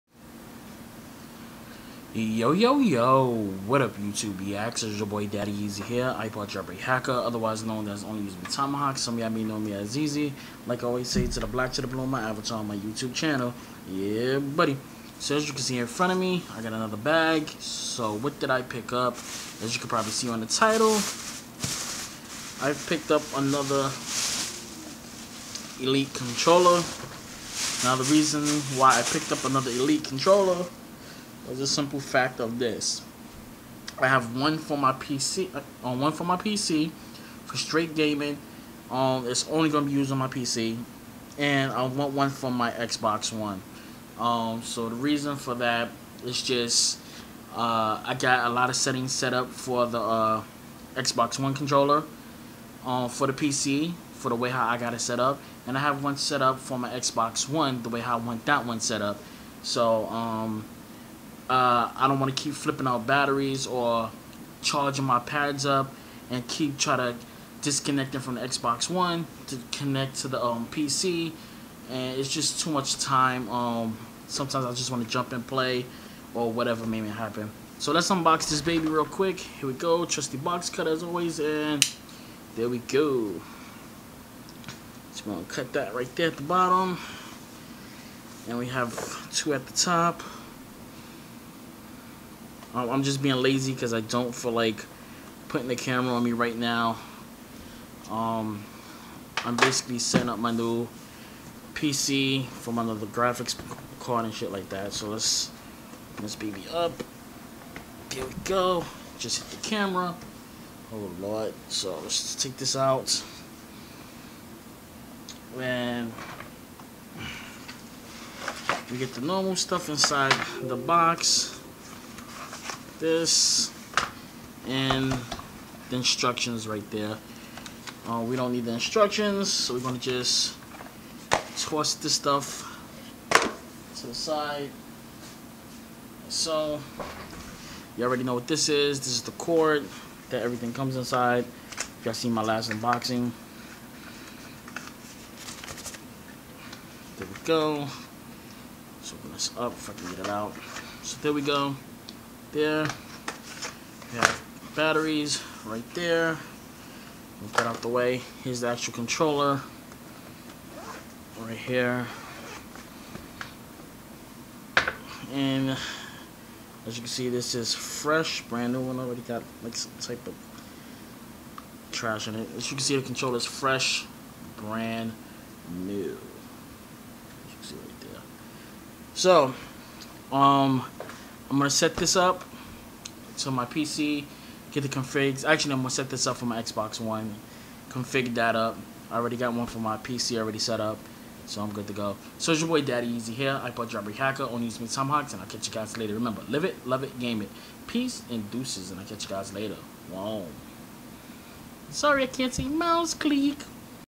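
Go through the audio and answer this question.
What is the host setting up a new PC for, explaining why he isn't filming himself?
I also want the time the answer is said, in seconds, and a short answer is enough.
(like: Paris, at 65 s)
graphics card, at 103 s.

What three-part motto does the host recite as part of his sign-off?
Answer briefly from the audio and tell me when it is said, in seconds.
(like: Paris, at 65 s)
live it, love it, game it, at 196 s.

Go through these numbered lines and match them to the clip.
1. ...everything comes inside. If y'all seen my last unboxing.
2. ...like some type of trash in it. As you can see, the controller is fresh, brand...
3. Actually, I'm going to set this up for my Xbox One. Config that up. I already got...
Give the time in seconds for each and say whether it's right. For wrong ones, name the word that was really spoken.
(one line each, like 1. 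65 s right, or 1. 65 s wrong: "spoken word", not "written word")
1. 140 s right
2. 169 s right
3. 185 s right.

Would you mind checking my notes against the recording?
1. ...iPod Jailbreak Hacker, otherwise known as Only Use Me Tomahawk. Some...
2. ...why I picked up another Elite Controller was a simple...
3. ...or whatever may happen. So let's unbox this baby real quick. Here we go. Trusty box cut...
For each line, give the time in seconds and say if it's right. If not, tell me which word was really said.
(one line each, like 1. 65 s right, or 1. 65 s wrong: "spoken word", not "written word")
1. 6 s right
2. 28 s right
3. 76 s right.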